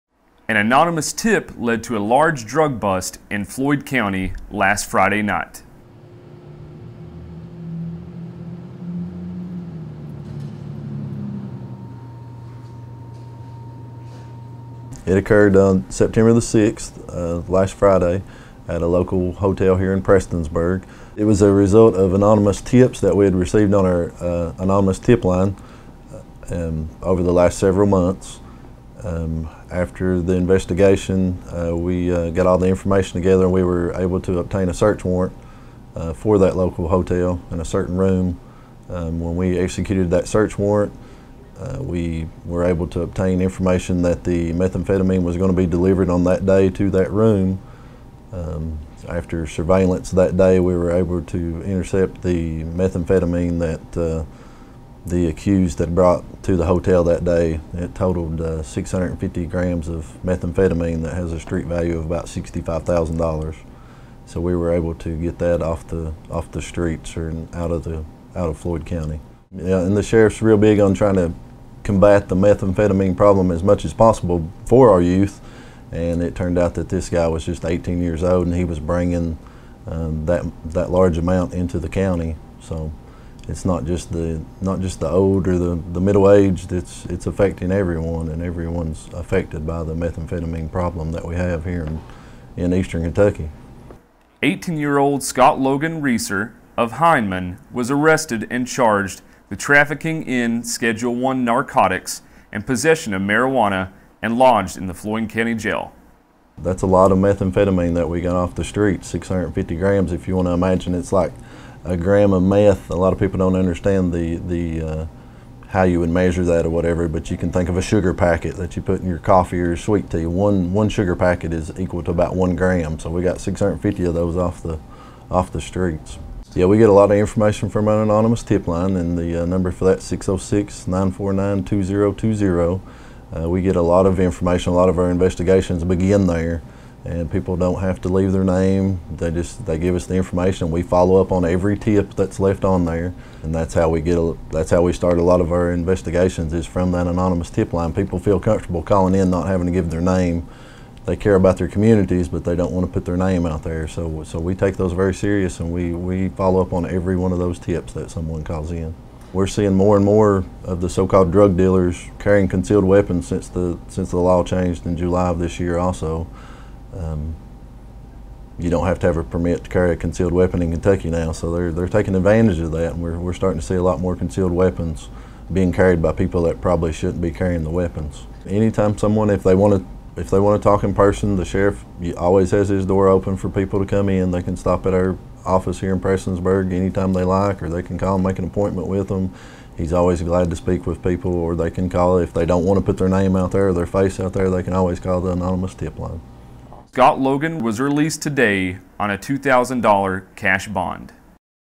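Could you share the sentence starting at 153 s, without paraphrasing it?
So so we take those very serious, and we we follow up on every one of those tips that someone calls in.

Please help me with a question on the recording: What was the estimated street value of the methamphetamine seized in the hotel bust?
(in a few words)
$65,000.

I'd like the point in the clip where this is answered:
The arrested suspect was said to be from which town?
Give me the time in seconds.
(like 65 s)
96 s.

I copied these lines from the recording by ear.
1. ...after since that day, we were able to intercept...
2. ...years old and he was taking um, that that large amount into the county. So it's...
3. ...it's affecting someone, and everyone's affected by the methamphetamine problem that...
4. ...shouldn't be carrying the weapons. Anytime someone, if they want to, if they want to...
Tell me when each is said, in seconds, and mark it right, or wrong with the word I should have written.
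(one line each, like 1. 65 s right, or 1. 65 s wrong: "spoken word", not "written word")
1. 49 s wrong: "surveillance", not "since"
2. 78 s wrong: "bringing", not "taking"
3. 87 s wrong: "everyone", not "someone"
4. 176 s right.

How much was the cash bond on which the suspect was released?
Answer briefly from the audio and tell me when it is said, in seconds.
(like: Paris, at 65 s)
$2,000, at 199 s.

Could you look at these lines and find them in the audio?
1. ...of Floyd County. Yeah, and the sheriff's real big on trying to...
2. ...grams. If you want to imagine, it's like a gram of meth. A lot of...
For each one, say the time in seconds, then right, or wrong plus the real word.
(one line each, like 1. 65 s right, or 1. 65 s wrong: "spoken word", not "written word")
1. 68 s right
2. 109 s right.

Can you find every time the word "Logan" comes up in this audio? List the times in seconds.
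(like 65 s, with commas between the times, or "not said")
95 s, 197 s.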